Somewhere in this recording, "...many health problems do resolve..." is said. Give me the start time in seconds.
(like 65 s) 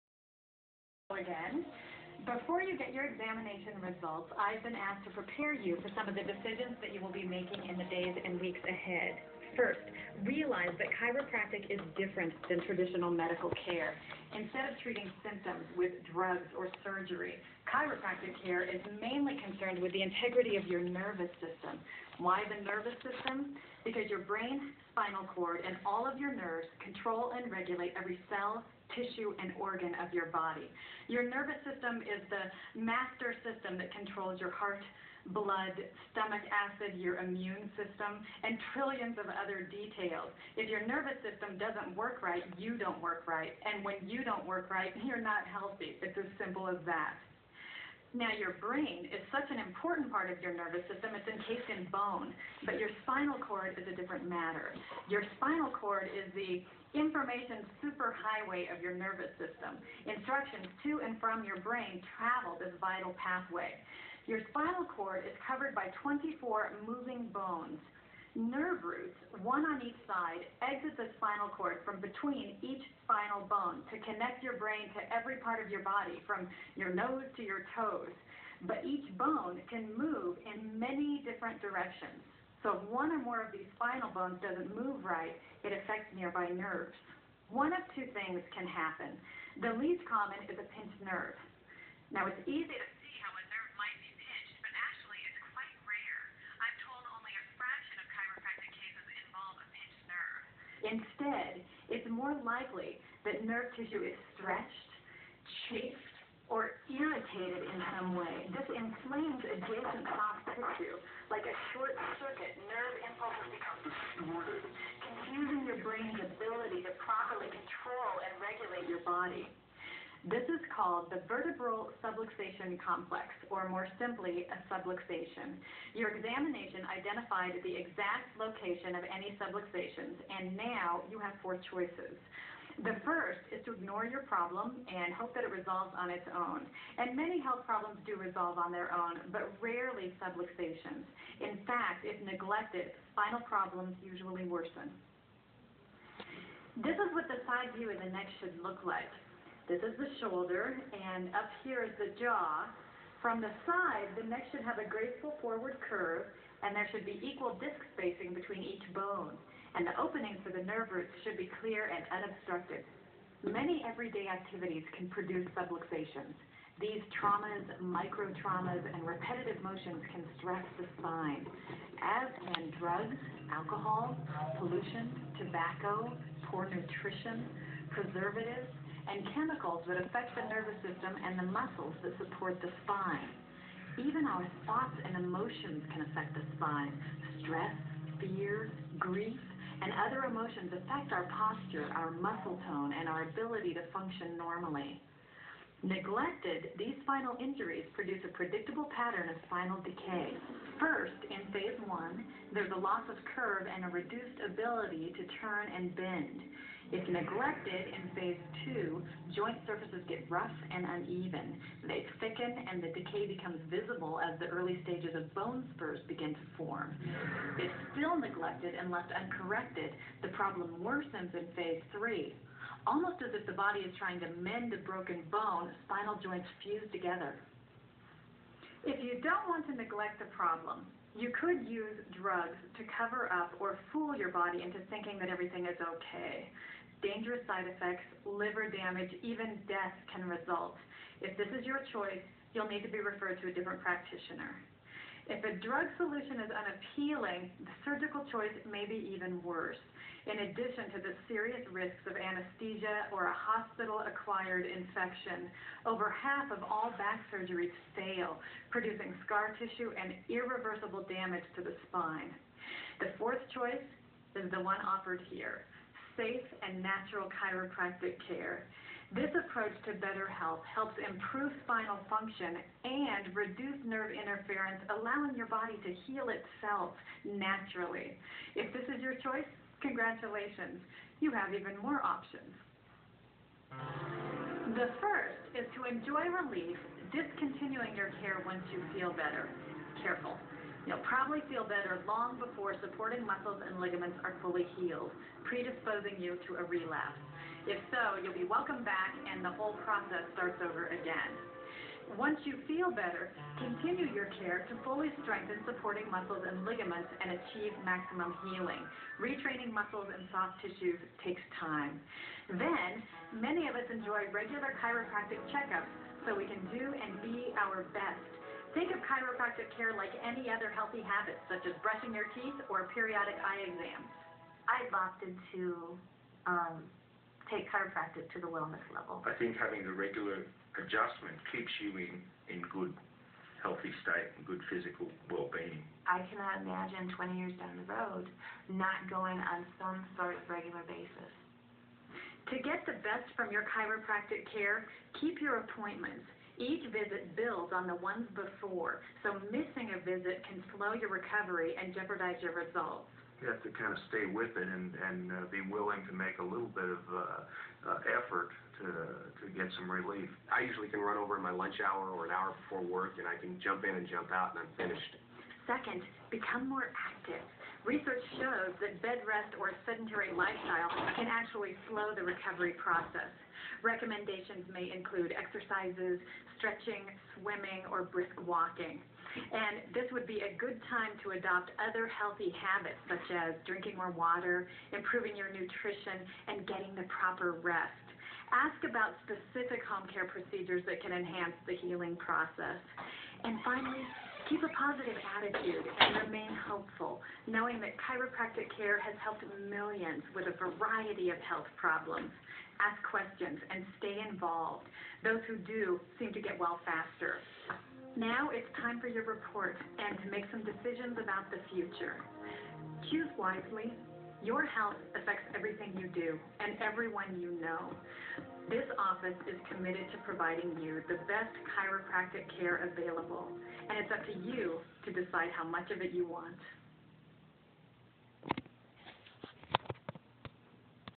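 137 s.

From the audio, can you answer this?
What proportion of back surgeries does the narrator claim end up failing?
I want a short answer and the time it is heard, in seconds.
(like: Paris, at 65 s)
Over half, at 255 s.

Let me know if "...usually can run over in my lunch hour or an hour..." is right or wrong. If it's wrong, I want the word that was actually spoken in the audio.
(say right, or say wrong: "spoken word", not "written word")
right.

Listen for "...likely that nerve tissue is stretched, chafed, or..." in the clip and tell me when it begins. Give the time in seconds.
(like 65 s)
102 s.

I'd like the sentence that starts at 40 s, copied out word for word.
If your nervous system doesn't work right, you don't work right.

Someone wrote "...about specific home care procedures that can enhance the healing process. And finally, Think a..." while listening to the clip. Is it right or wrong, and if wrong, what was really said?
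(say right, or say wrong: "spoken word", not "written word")
wrong: "Keep", not "Think".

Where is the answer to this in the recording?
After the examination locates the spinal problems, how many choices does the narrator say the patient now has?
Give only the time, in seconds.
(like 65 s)
131 s.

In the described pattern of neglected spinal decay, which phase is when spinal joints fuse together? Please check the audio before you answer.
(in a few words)
phase three.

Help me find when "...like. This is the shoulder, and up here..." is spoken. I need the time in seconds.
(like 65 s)
148 s.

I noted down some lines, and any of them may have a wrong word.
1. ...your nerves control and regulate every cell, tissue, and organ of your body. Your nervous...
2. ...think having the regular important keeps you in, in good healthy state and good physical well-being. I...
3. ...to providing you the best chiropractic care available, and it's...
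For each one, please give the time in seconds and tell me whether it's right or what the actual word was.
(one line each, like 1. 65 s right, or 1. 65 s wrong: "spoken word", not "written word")
1. 26 s right
2. 329 s wrong: "adjustment", not "important"
3. 420 s right.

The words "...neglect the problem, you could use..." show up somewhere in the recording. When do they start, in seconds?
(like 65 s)
229 s.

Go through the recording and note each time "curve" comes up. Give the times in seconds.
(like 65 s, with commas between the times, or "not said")
155 s, 203 s.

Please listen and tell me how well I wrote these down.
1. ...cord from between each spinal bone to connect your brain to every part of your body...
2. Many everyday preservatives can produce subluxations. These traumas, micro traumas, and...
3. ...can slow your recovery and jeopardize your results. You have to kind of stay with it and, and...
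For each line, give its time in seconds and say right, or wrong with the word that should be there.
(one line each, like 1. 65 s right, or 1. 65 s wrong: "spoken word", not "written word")
1. 71 s right
2. 163 s wrong: "activities", not "preservatives"
3. 350 s right.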